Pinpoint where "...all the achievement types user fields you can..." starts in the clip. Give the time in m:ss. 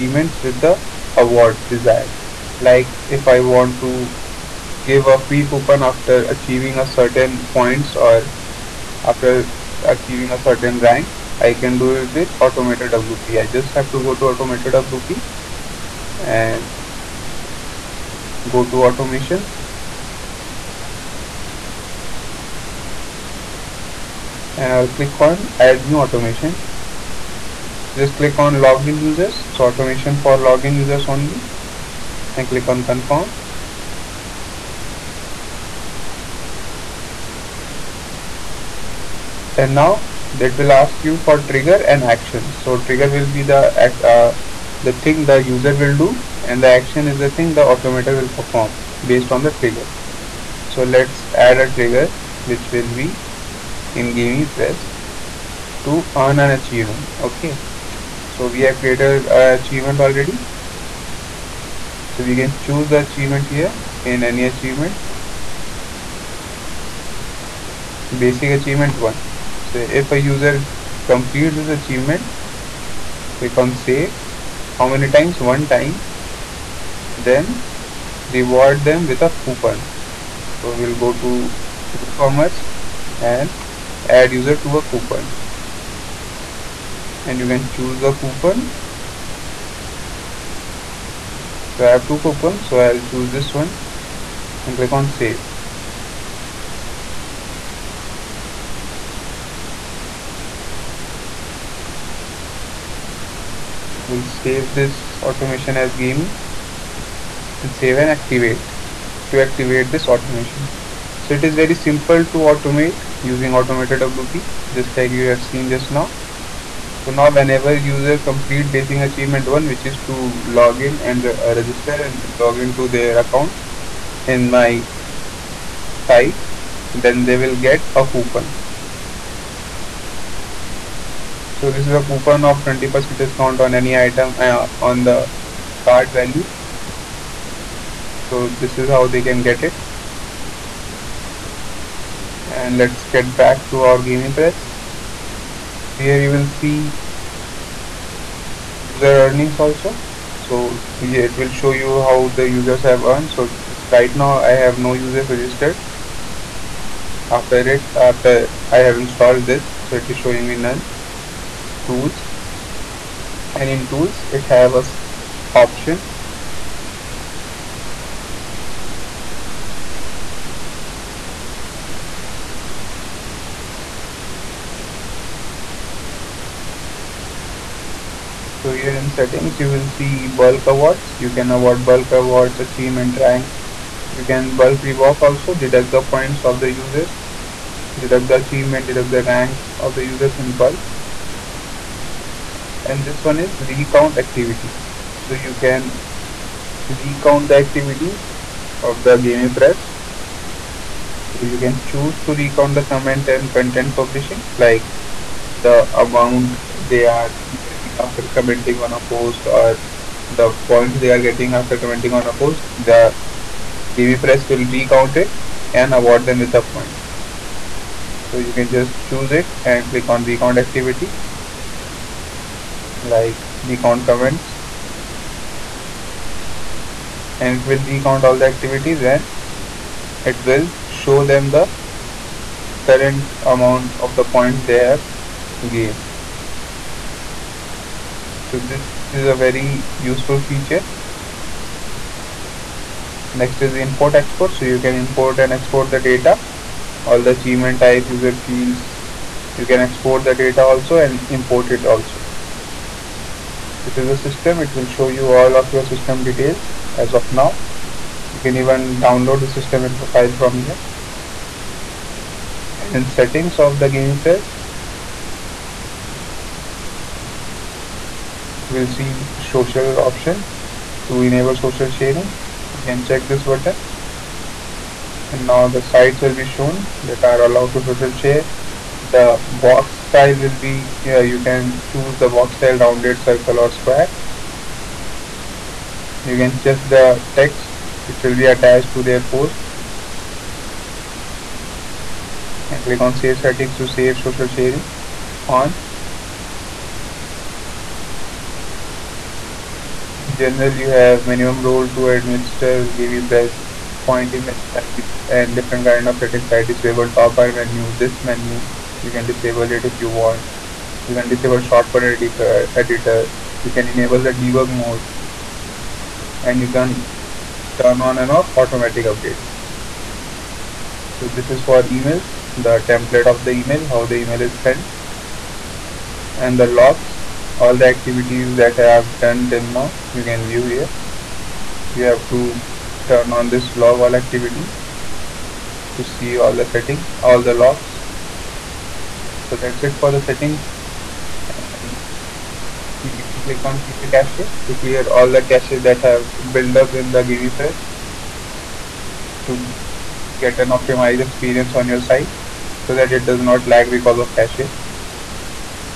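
4:07.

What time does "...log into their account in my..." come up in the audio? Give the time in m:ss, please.
2:02.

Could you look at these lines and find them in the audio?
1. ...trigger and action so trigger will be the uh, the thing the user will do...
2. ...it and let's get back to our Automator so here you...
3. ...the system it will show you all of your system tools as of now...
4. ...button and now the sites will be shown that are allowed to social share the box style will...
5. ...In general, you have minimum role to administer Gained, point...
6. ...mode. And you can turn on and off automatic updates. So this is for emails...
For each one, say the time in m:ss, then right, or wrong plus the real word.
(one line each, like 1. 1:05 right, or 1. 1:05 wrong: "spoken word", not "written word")
1. 0:41 right
2. 2:19 wrong: "GamiPress", not "Automator"
3. 4:14 wrong: "details", not "tools"
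4. 4:33 right
5. 5:00 wrong: "GamiPress", not "Gained"
6. 5:14 right.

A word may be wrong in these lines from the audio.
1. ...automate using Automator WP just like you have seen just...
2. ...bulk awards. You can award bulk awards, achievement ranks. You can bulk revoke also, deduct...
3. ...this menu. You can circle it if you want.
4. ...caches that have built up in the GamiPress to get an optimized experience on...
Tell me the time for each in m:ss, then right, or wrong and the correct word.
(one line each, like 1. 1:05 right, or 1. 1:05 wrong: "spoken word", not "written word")
1. 1:52 right
2. 3:00 right
3. 5:07 wrong: "disable", not "circle"
4. 5:45 right.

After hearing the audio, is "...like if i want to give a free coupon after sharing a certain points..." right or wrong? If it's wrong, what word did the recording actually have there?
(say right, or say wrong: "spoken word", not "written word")
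wrong: "achieving", not "sharing".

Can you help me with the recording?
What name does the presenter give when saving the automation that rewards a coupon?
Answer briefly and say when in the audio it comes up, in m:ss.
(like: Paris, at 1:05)
gaming, at 1:45.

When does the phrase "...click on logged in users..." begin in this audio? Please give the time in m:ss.
0:28.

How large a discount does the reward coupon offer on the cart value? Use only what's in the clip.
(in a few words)
20%.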